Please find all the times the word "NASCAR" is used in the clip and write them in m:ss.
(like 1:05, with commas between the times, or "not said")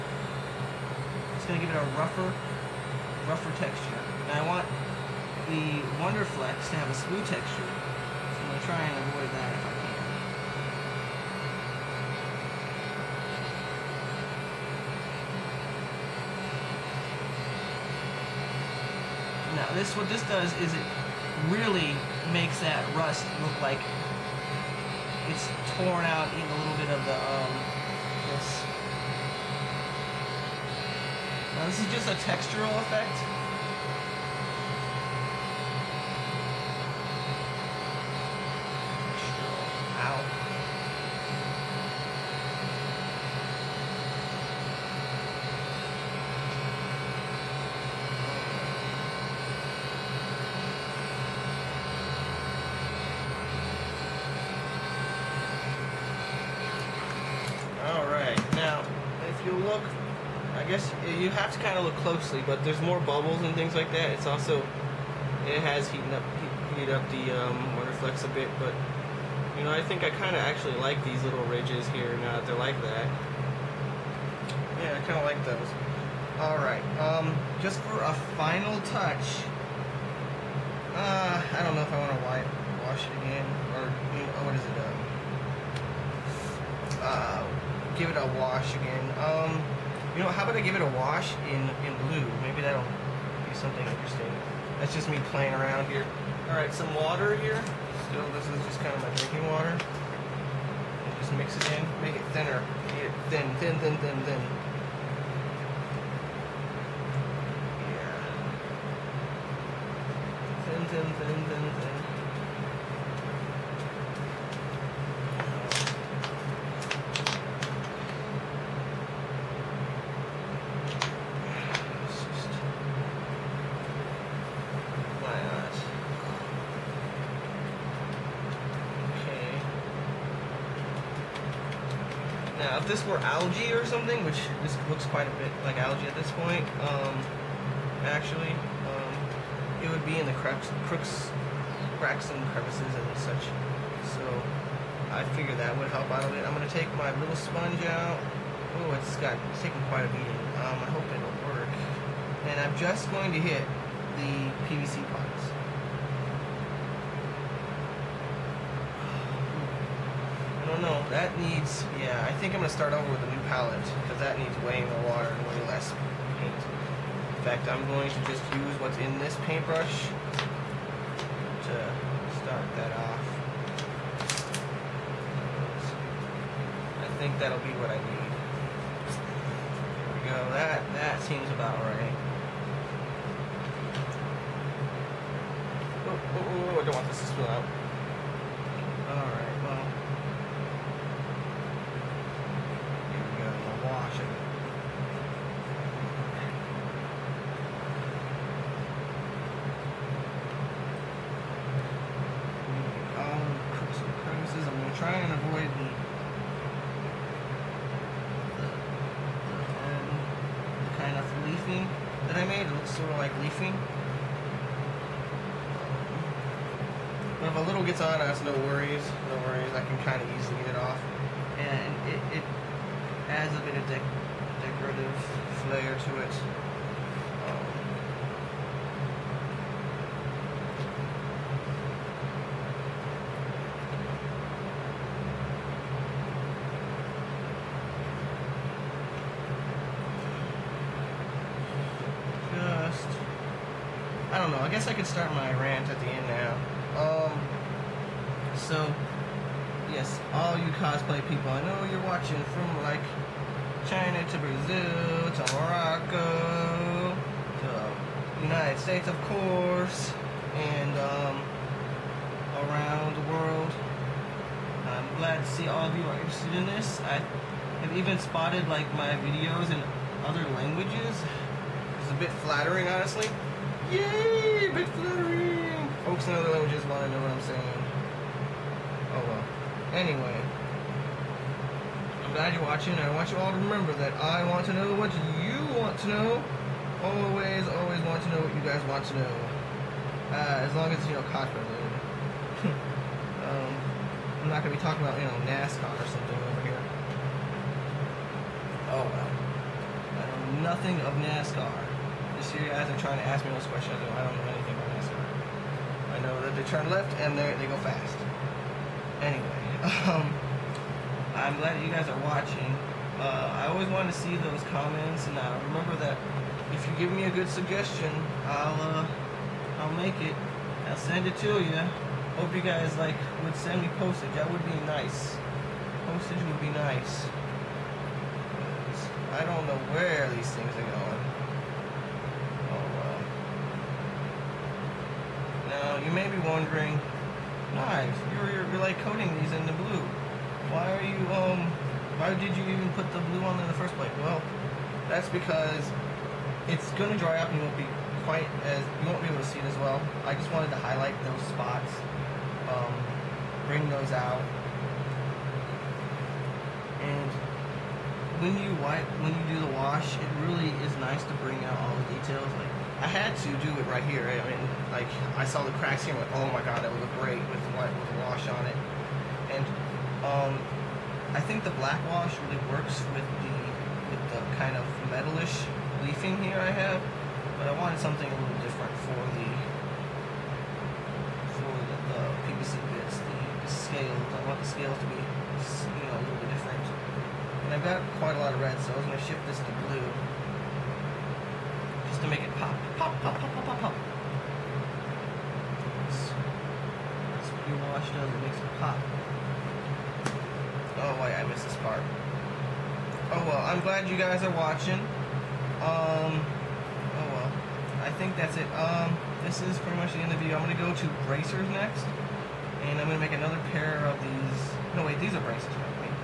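4:55, 5:01.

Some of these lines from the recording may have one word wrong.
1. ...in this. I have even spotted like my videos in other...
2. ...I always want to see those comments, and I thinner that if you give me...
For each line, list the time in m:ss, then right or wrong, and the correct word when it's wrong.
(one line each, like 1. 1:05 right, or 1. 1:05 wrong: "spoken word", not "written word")
1. 4:26 right
2. 5:13 wrong: "remember", not "thinner".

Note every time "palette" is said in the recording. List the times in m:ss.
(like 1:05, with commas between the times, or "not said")
2:43.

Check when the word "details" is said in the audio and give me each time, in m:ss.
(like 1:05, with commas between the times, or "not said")
6:02.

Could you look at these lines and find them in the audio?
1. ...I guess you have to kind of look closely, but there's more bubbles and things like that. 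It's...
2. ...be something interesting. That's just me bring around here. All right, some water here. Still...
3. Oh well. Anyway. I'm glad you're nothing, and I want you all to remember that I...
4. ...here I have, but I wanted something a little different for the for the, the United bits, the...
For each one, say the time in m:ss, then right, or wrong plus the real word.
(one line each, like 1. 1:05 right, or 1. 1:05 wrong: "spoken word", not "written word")
1. 1:00 right
2. 1:32 wrong: "playing", not "bring"
3. 4:39 wrong: "watching", not "nothing"
4. 6:16 wrong: "PVC", not "United".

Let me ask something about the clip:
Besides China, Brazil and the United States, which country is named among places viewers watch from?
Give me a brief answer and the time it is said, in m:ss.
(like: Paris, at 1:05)
Morocco, at 4:15.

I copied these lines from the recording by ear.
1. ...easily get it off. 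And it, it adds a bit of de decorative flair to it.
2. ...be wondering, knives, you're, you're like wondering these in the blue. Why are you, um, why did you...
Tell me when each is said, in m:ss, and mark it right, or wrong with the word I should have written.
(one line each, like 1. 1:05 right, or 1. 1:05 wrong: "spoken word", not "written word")
1. 3:40 right
2. 5:36 wrong: "coating", not "wondering".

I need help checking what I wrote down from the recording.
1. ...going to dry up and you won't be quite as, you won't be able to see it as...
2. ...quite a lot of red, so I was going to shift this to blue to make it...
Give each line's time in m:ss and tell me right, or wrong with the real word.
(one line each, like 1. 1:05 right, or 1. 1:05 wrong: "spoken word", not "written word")
1. 5:47 right
2. 6:28 right.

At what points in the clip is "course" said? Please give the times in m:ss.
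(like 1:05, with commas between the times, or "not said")
4:19.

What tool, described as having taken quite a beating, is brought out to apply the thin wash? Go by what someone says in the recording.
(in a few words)
Sponge.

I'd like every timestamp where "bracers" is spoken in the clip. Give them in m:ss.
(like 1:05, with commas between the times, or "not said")
6:51, 6:55.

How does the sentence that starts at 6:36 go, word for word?
That's what you wash does, it makes it pop.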